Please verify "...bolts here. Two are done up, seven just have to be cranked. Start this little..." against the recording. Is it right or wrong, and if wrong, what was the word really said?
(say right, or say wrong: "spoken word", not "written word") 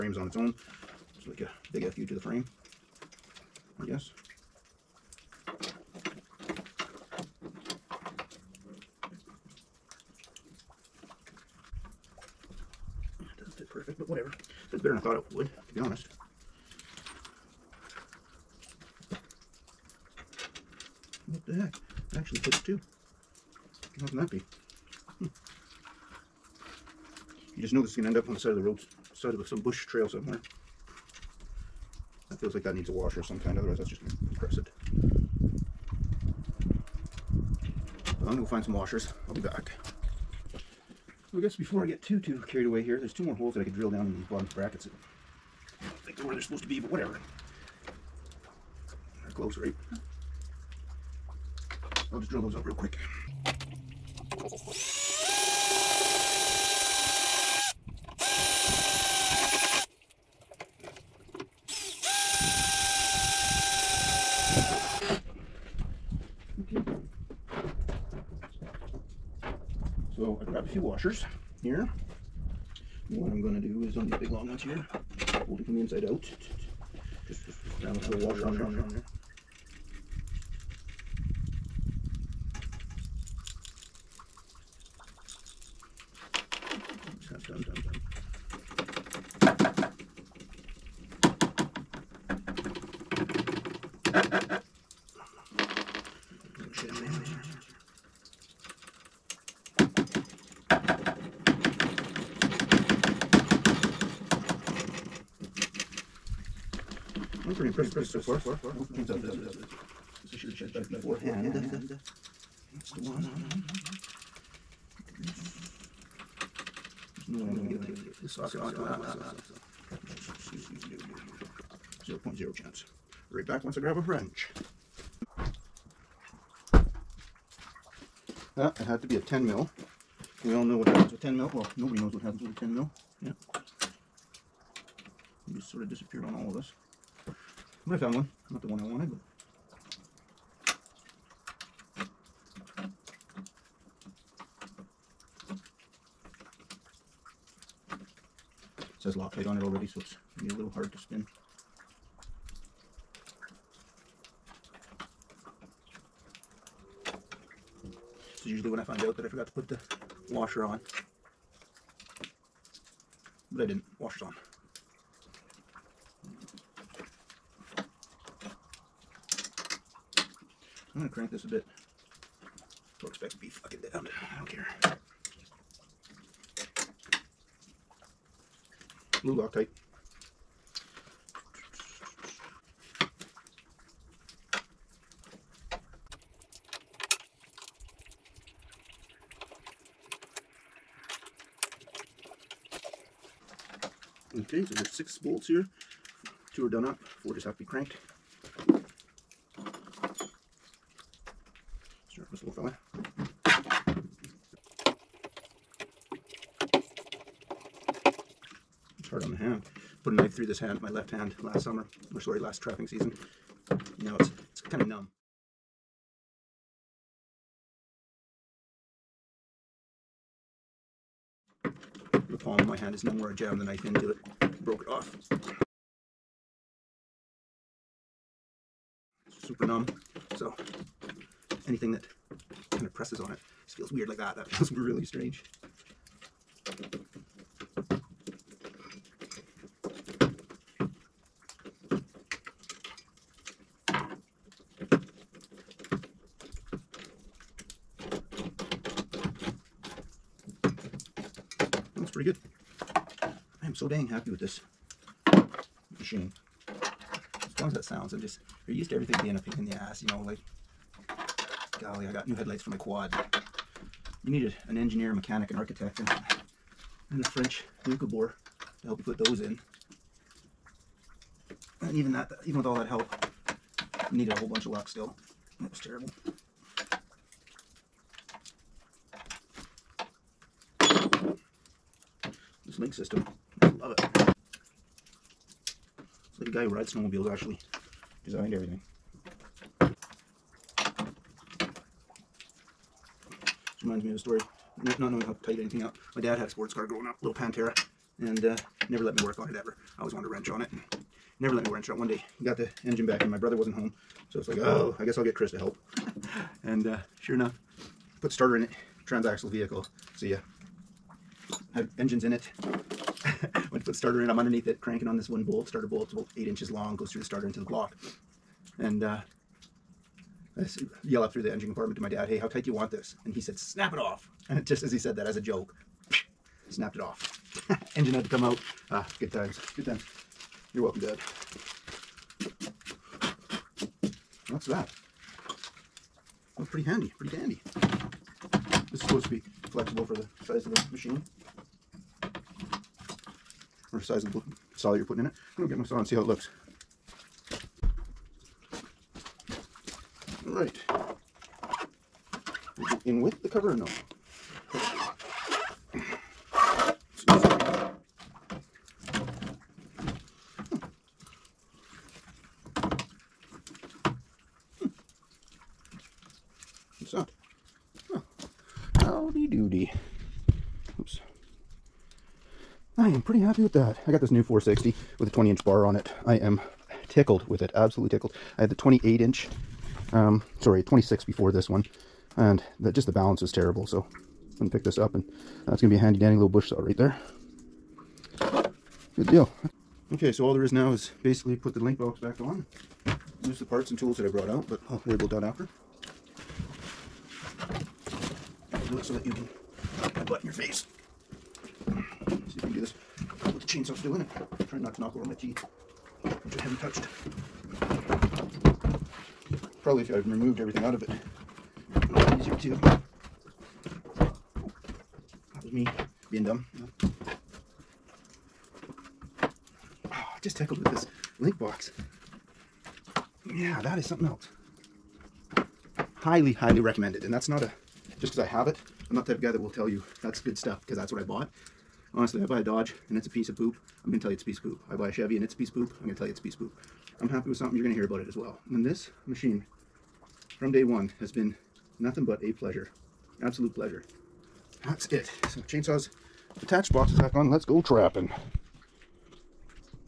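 wrong: "four", not "seven".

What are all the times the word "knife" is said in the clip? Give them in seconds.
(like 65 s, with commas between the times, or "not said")
210 s, 223 s.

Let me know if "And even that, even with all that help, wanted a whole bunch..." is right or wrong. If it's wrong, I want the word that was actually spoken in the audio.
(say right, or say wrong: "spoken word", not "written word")
wrong: "needed", not "wanted".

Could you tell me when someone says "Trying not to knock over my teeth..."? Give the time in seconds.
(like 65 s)
404 s.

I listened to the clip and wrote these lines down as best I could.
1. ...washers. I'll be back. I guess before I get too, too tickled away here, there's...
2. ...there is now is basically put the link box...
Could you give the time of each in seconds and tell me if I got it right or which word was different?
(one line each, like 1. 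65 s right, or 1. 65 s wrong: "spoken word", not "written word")
1. 38 s wrong: "carried", not "tickled"
2. 390 s right.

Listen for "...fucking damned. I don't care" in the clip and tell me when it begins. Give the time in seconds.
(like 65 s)
173 s.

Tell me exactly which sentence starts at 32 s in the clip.
That feels like that needs a washer of some kind, otherwise that's just going to press it.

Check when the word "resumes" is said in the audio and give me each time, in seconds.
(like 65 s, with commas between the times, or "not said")
not said.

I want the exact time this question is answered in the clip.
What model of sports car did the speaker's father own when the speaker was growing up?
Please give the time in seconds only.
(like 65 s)
297 s.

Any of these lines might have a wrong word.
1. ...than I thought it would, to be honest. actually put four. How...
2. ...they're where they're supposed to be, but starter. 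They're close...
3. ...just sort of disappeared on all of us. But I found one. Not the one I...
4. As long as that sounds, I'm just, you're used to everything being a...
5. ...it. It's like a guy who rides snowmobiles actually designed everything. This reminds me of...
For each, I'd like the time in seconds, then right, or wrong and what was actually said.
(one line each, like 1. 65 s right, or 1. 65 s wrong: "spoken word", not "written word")
1. 14 s wrong: "two", not "four"
2. 46 s wrong: "whatever", not "starter"
3. 135 s right
4. 256 s right
5. 283 s right.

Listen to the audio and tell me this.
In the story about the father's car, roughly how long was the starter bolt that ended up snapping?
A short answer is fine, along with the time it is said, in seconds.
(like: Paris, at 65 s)
8 inches, at 316 s.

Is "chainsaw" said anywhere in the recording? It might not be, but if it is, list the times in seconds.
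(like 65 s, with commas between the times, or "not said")
108 s, 403 s, 445 s.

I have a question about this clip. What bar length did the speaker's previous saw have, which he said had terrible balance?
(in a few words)
26 inch.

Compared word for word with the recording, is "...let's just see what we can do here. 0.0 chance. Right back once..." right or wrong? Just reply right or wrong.
right.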